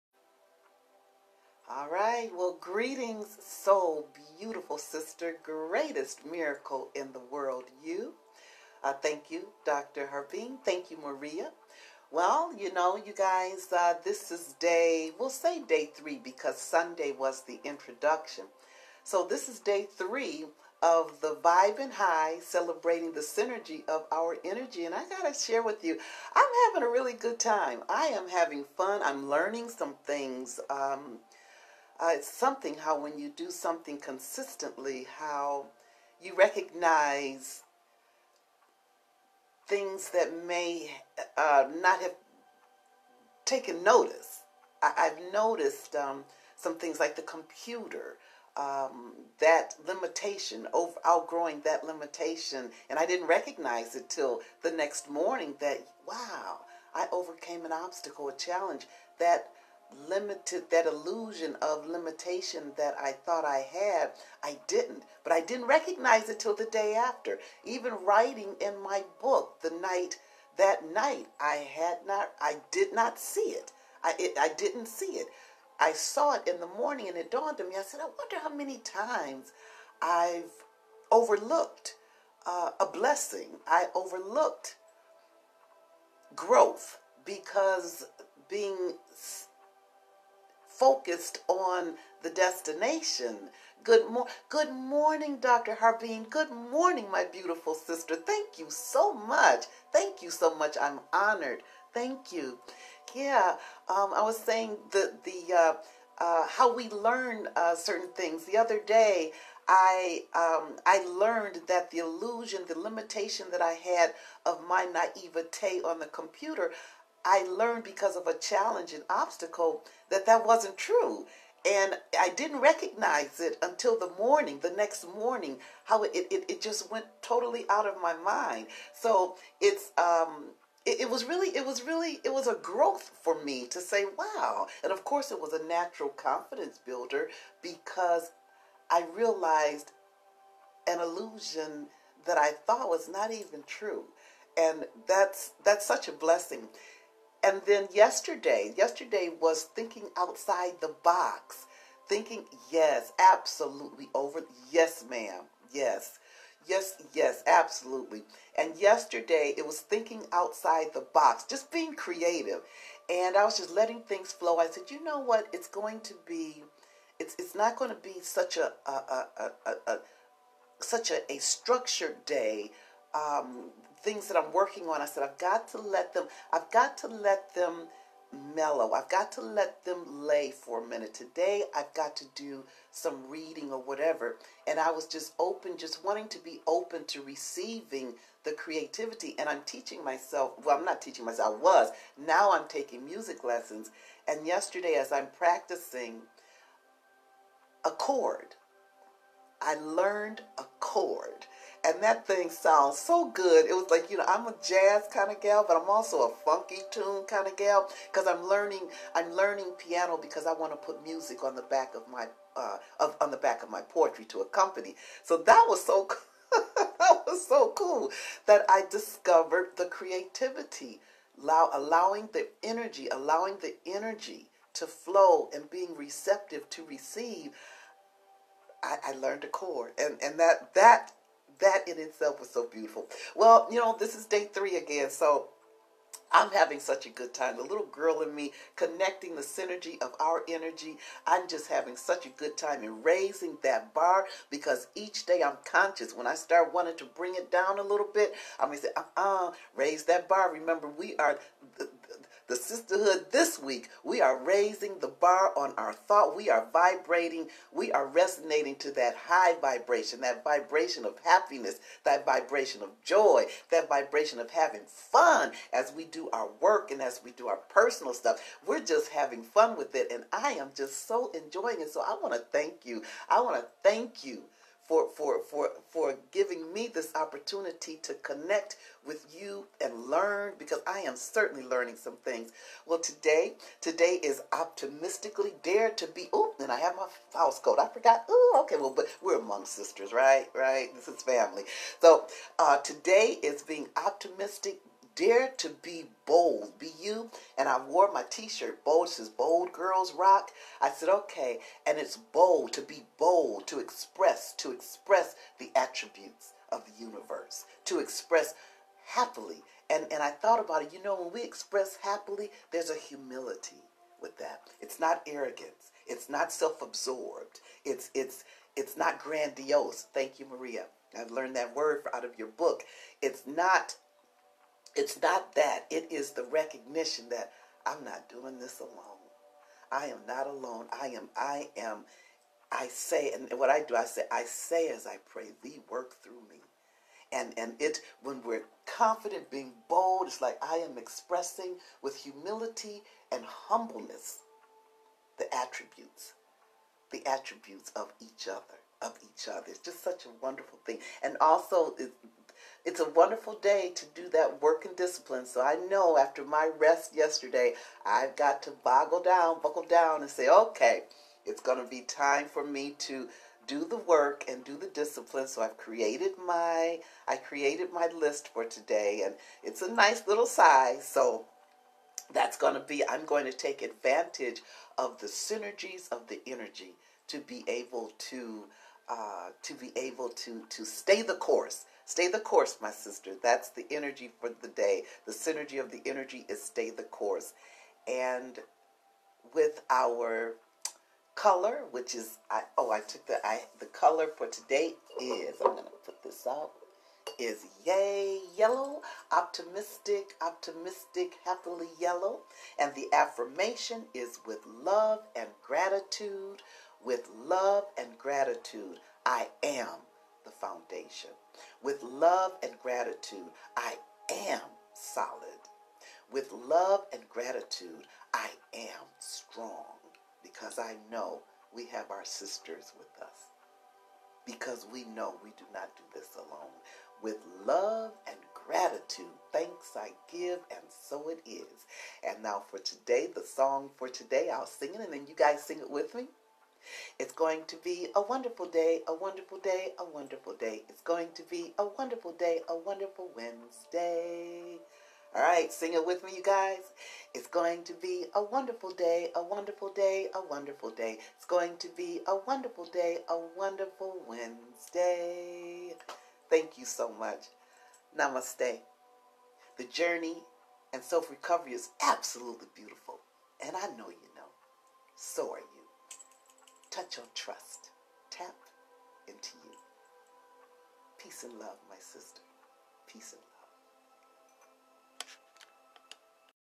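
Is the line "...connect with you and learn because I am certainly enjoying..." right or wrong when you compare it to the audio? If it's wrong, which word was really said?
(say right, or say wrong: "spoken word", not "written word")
wrong: "learning", not "enjoying".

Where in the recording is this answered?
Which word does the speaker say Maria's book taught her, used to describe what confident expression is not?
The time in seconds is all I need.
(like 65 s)
319 s.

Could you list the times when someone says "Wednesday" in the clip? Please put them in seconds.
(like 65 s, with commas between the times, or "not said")
443 s, 454 s.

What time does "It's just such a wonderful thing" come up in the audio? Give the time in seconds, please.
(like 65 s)
349 s.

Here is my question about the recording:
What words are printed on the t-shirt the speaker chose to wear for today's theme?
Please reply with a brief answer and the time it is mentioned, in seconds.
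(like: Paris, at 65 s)
Bold Girls Rock, at 299 s.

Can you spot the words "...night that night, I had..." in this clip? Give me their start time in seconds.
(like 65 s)
69 s.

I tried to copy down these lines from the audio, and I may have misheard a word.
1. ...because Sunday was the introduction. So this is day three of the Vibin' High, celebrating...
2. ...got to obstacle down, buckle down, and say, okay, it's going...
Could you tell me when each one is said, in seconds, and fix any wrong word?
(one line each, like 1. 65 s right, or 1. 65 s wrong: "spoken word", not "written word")
1. 16 s right
2. 358 s wrong: "boggle", not "obstacle".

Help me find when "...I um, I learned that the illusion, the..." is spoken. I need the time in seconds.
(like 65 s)
109 s.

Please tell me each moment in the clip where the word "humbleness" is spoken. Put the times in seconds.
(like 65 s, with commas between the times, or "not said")
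343 s.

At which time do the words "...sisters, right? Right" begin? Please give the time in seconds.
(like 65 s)
289 s.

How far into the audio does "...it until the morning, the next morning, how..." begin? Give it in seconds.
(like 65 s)
123 s.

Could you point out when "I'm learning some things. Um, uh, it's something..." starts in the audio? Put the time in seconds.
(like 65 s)
29 s.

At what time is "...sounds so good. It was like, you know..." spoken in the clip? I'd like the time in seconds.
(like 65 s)
202 s.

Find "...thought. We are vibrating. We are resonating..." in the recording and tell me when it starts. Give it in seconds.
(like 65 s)
255 s.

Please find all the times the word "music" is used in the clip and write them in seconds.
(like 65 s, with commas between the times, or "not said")
193 s, 211 s.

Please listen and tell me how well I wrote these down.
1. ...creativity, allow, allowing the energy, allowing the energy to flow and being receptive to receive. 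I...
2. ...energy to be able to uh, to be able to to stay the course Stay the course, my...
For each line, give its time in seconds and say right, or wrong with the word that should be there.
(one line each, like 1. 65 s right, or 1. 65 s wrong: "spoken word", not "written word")
1. 219 s right
2. 376 s right.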